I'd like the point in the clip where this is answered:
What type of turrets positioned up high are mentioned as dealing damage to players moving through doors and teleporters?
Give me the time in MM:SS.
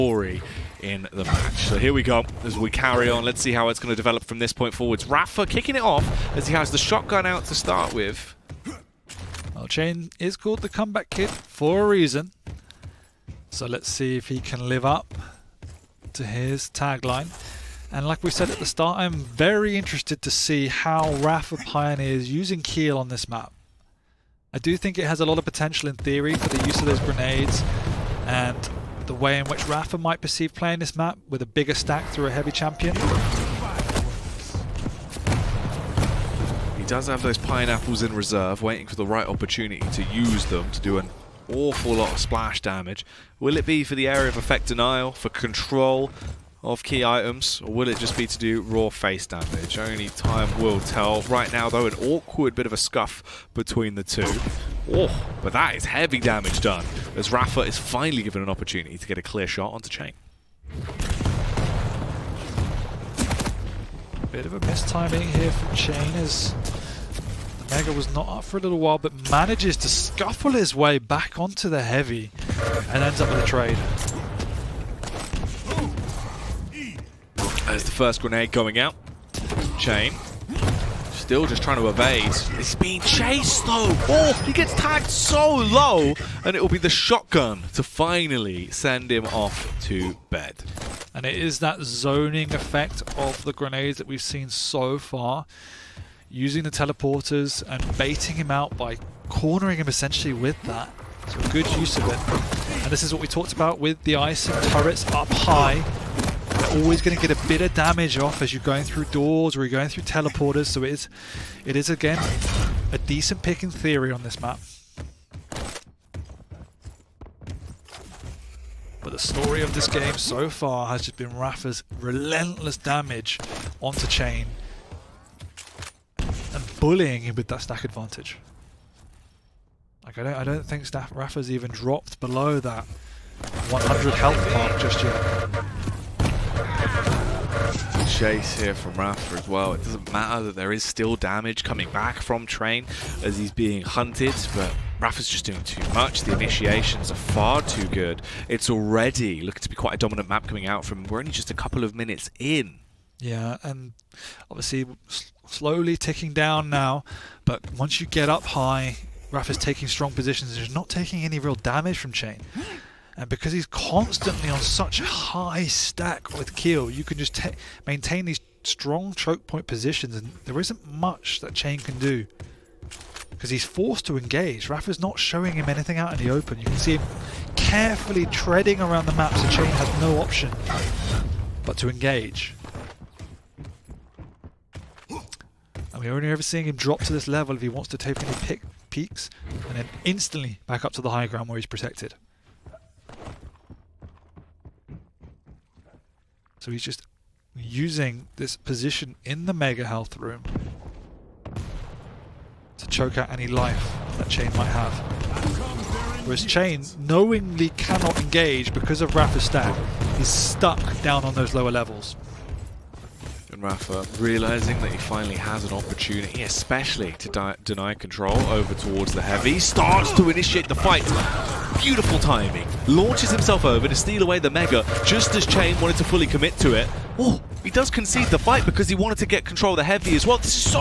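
01:44.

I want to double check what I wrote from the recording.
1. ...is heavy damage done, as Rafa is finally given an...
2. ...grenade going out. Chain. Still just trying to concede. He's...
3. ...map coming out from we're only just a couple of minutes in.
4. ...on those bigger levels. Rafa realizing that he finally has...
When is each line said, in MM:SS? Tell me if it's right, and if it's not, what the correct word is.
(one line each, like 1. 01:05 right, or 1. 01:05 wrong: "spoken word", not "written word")
1. 00:55 right
2. 01:18 wrong: "evade", not "concede"
3. 02:30 right
4. 03:31 wrong: "lower", not "bigger".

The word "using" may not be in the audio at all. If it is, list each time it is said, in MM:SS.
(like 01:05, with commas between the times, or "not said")
00:22, 01:36, 03:17.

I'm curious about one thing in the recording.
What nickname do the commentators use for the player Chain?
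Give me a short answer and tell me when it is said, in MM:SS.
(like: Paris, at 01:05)
The comeback kid, at 00:10.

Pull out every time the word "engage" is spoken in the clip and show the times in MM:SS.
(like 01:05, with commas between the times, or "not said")
02:54, 03:01, 03:28.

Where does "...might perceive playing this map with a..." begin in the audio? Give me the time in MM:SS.
00:29.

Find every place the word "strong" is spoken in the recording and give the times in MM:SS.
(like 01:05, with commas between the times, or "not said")
02:39, 02:48.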